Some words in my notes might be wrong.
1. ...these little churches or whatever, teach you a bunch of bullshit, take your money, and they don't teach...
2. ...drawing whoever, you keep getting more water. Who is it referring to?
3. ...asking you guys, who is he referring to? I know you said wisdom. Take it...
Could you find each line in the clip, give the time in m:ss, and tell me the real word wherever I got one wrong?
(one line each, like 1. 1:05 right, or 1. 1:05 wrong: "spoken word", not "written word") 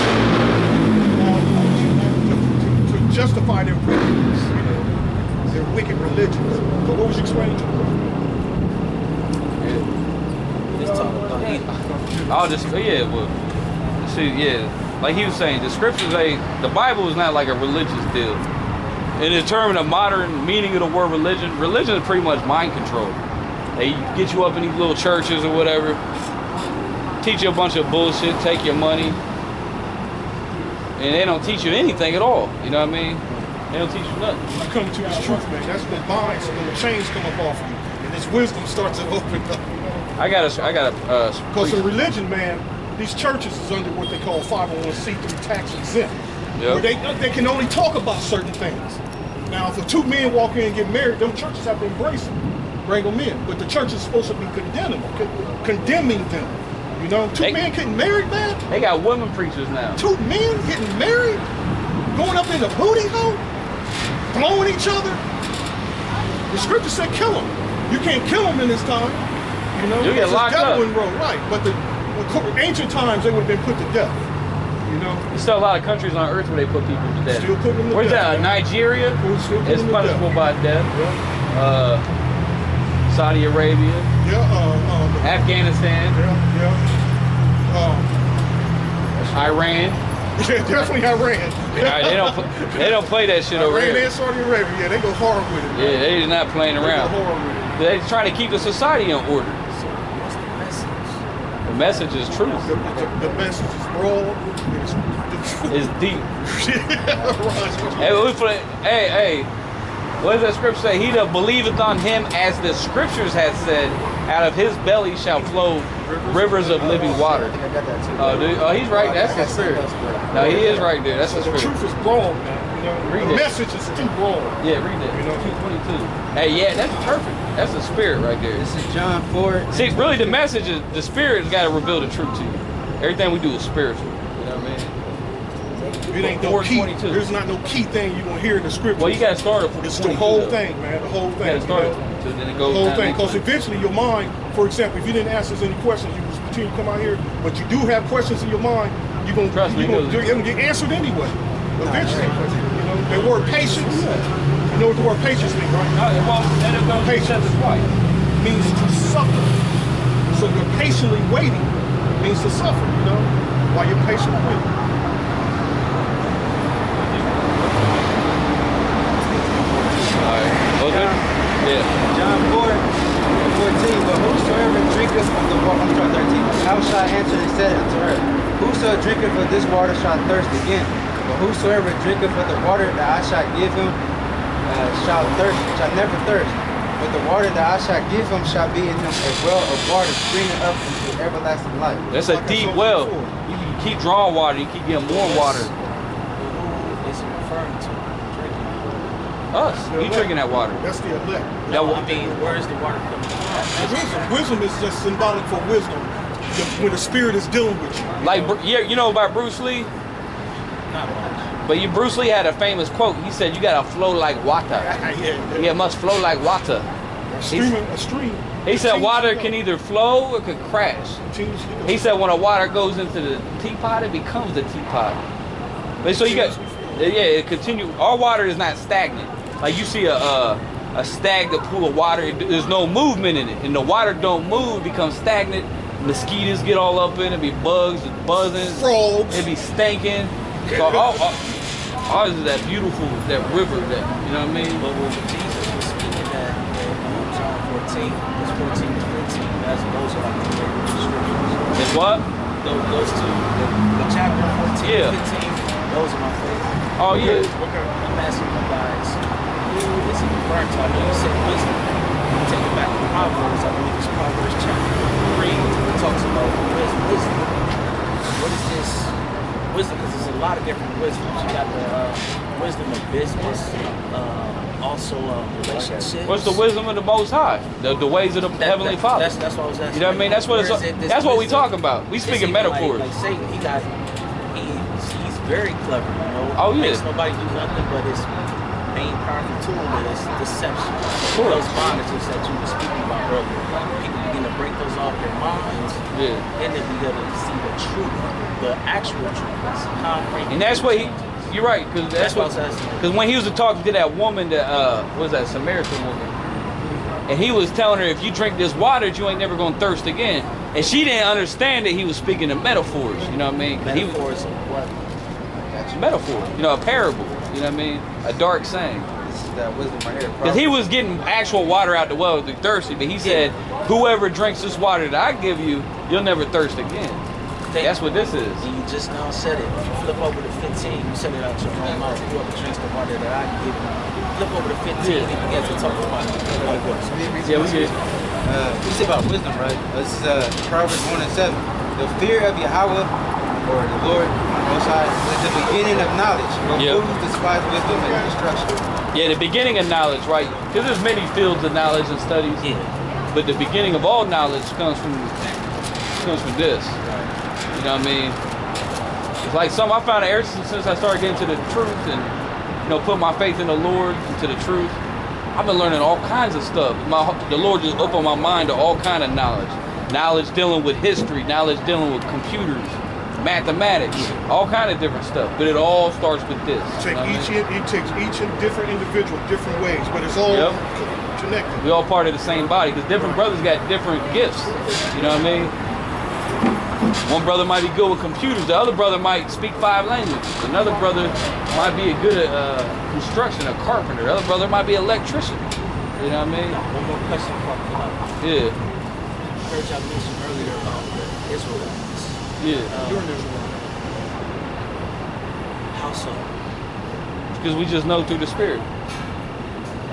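1. 0:24 right
2. 3:13 wrong: "water", not "whoever"
3. 4:18 right.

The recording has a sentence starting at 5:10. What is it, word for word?
And she didn't understand that he was speaking in metaphors.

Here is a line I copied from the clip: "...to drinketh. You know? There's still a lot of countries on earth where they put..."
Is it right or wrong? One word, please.
wrong.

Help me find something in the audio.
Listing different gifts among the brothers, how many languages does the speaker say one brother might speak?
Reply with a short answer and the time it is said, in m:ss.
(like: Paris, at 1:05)
5, at 6:29.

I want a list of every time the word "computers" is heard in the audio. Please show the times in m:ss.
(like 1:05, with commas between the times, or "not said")
6:12, 6:28.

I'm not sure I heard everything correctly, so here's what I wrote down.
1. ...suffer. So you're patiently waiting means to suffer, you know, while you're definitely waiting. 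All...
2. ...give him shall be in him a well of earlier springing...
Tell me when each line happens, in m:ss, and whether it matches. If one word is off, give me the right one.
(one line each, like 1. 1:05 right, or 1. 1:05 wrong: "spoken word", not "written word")
1. 2:39 wrong: "patiently", not "definitely"
2. 3:08 wrong: "water", not "earlier".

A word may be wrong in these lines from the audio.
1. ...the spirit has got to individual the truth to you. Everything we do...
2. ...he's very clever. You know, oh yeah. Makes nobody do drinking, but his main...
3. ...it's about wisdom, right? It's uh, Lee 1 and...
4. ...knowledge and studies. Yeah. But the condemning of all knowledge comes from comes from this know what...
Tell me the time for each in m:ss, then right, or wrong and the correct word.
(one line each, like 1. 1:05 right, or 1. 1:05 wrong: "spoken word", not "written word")
1. 2:10 wrong: "reveal", not "individual"
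2. 4:44 wrong: "nothing", not "drinking"
3. 5:38 wrong: "Proverbs", not "Lee"
4. 5:51 wrong: "beginning", not "condemning".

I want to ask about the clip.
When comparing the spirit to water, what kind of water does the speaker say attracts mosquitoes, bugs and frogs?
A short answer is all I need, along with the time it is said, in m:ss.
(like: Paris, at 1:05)
stagnant pool, at 3:51.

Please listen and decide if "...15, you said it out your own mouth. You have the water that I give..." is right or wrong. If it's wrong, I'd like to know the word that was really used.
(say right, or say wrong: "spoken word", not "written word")
right.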